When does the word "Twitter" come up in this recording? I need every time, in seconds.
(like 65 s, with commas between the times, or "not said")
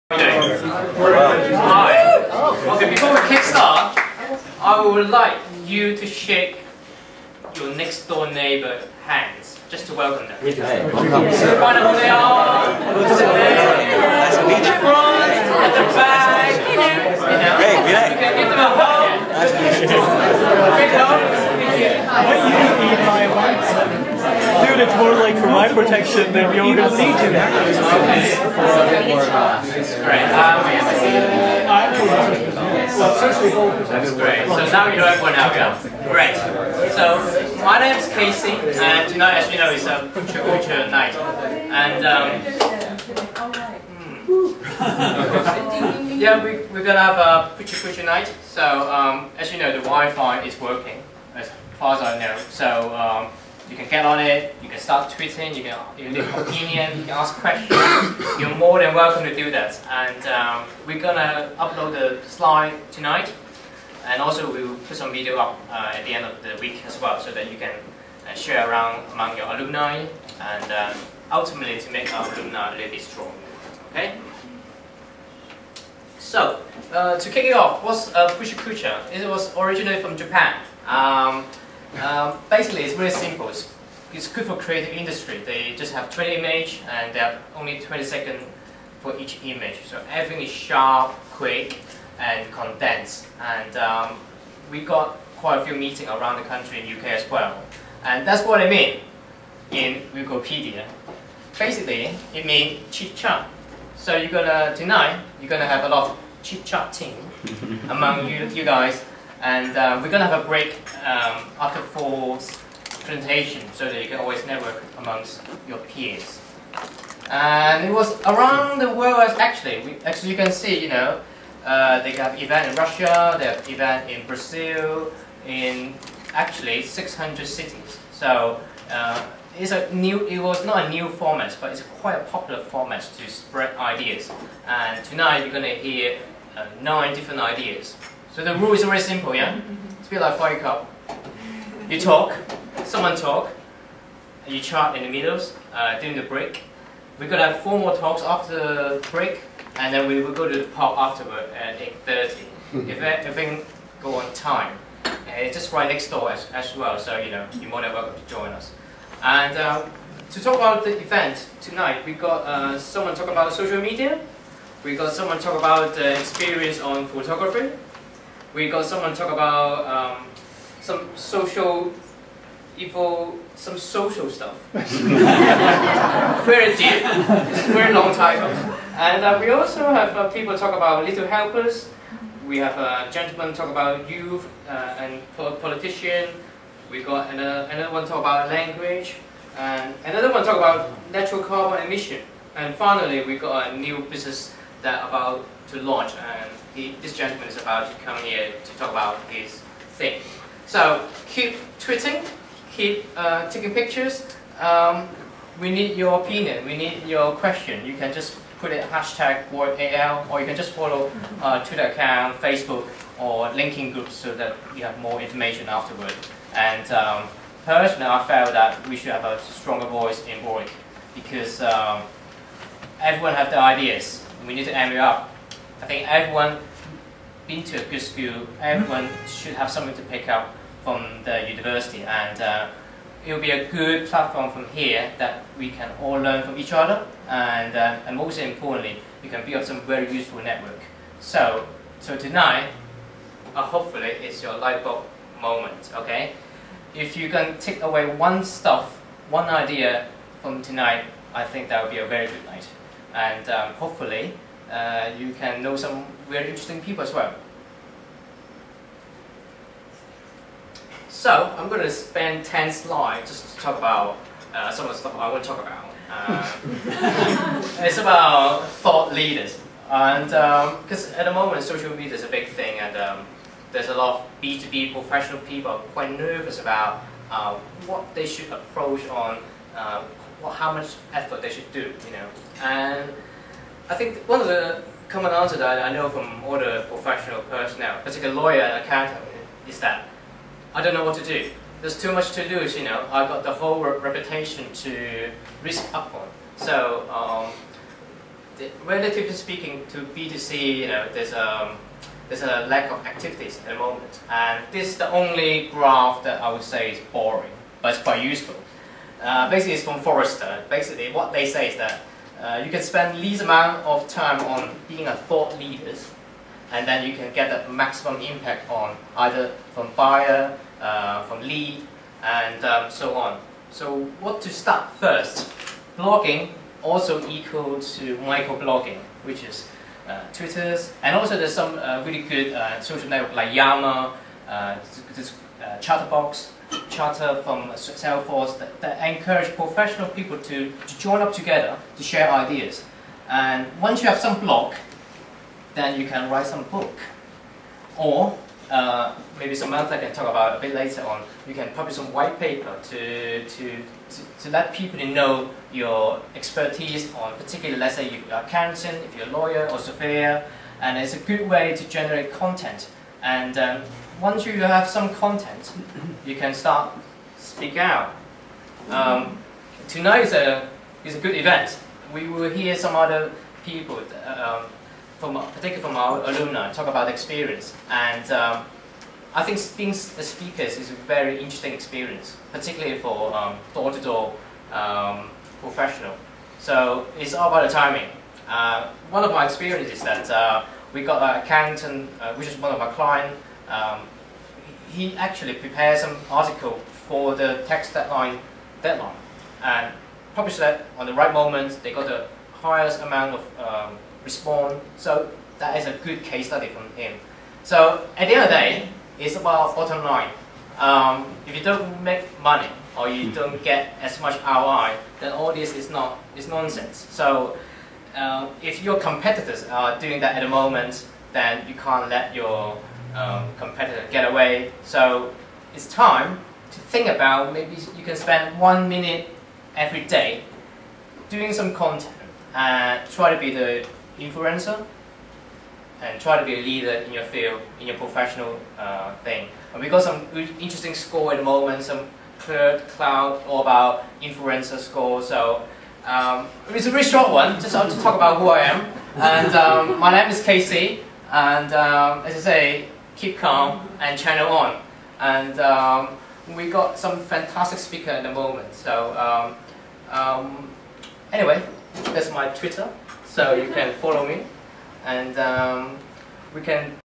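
211 s, 330 s, 462 s.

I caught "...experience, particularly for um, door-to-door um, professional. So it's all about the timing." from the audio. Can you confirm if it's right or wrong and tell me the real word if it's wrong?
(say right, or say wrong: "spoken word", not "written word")
right.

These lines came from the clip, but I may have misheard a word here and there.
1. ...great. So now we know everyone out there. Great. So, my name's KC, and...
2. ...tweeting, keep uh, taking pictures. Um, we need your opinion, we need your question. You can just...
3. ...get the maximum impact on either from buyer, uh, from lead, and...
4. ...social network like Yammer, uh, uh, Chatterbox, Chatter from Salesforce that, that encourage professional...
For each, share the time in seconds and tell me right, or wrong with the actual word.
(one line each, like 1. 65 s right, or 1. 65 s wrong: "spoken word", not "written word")
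1. 34 s right
2. 201 s right
3. 317 s right
4. 332 s right.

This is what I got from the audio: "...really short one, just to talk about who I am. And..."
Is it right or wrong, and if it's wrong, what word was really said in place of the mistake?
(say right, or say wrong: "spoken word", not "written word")
right.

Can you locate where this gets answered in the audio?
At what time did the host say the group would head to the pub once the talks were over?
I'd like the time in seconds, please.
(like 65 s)
151 s.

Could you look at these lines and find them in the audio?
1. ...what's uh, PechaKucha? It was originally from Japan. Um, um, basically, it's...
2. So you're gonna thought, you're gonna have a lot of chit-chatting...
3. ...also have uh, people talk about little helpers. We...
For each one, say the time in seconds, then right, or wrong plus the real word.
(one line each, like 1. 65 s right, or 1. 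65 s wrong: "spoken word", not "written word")
1. 77 s right
2. 103 s wrong: "tonight", not "thought"
3. 179 s right.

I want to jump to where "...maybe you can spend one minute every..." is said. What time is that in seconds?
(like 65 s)
427 s.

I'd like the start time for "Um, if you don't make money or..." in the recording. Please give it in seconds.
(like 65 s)
410 s.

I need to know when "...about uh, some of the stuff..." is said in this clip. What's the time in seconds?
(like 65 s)
263 s.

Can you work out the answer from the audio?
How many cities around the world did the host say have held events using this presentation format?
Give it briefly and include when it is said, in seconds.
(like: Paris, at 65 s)
600, at 126 s.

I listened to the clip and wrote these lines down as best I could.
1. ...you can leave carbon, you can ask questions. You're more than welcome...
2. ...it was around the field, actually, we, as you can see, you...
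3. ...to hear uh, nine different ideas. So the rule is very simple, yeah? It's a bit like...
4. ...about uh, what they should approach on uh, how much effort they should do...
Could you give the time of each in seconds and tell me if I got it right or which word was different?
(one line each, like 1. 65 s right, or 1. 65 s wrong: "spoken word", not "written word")
1. 55 s wrong: "opinion", not "carbon"
2. 117 s wrong: "world", not "field"
3. 135 s right
4. 276 s right.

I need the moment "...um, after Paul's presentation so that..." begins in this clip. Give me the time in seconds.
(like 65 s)
111 s.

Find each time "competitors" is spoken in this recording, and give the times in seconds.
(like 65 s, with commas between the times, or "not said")
418 s, 423 s.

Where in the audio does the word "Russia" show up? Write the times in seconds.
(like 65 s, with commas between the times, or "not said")
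122 s.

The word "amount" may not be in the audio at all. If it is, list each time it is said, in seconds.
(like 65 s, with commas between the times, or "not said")
313 s, 403 s.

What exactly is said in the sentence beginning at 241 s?
So, so tonight, uh, hopefully it's your light bulb moment, okay?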